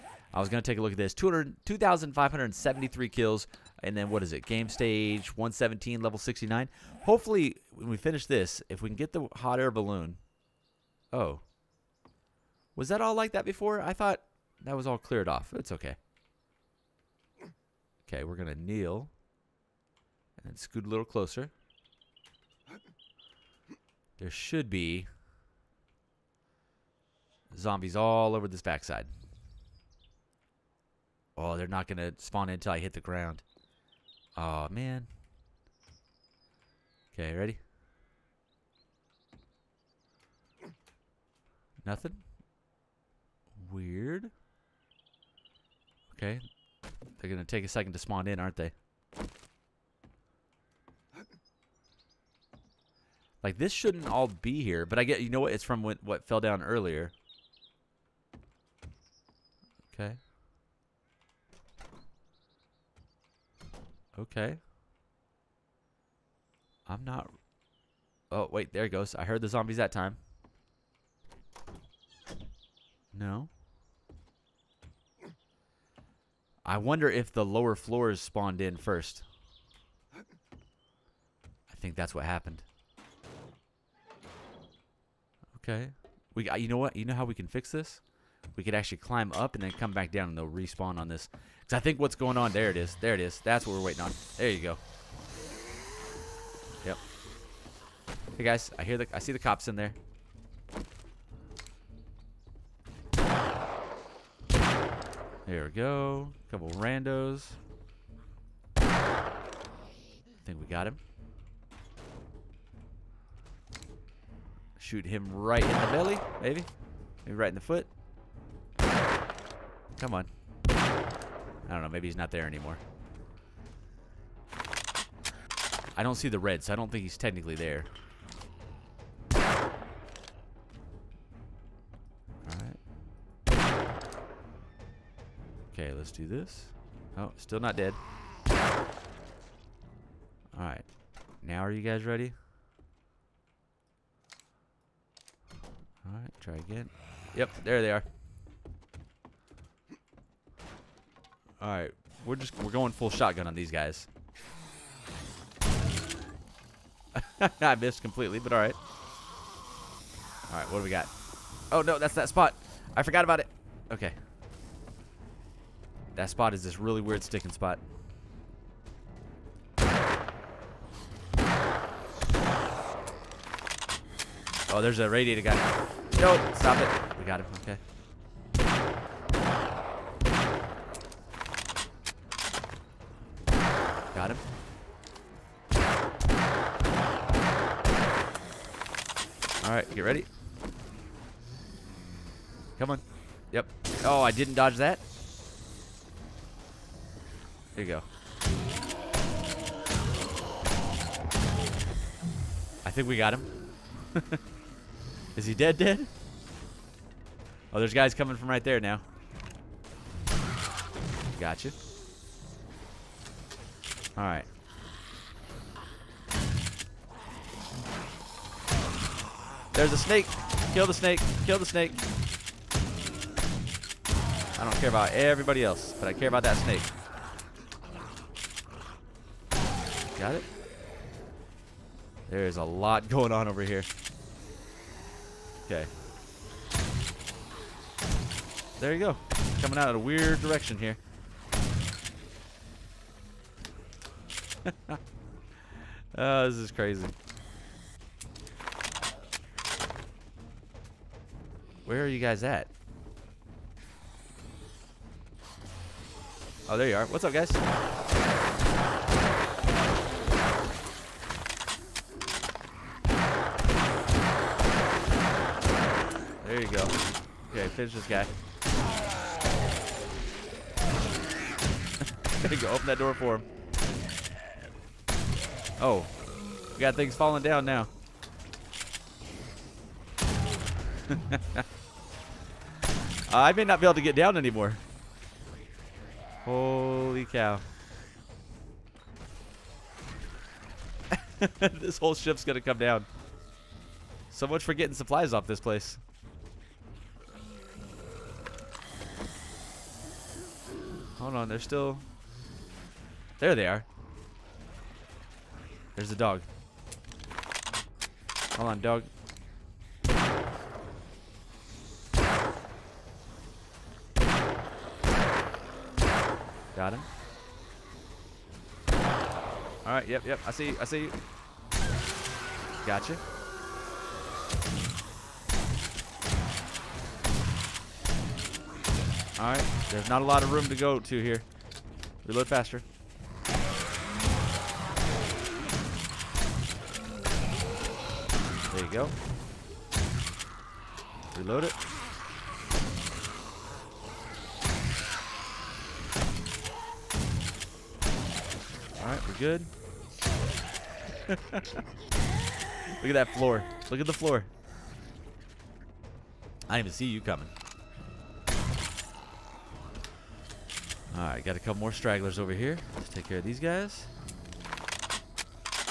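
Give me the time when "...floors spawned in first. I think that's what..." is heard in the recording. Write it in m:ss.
1:17.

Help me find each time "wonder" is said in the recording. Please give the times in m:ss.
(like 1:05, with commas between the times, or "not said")
1:16.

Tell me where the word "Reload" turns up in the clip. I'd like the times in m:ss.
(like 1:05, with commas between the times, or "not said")
5:32, 5:41.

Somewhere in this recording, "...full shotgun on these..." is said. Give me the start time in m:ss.
2:32.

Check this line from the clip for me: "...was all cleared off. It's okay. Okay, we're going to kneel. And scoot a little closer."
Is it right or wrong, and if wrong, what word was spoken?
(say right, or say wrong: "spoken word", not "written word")
right.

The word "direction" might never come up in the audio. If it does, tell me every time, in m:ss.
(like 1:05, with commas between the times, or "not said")
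4:00.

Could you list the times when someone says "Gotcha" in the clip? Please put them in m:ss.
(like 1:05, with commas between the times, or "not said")
3:31, 5:22.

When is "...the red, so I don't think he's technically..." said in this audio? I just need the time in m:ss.
2:06.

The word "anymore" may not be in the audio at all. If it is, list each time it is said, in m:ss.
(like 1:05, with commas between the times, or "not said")
2:02, 4:44.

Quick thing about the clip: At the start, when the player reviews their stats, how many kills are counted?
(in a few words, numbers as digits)
2,573.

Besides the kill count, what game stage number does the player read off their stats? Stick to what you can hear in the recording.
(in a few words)
117.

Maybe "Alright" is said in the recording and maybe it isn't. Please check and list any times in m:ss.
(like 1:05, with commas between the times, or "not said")
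2:09, 2:20, 2:26, 3:09, 3:34.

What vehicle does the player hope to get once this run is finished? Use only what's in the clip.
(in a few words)
hot air balloon.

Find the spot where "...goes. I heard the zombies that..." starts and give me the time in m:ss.
1:08.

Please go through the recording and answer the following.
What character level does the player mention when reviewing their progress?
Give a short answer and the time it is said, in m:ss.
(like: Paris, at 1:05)
69, at 0:06.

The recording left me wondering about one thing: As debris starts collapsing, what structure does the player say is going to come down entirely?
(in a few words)
ship.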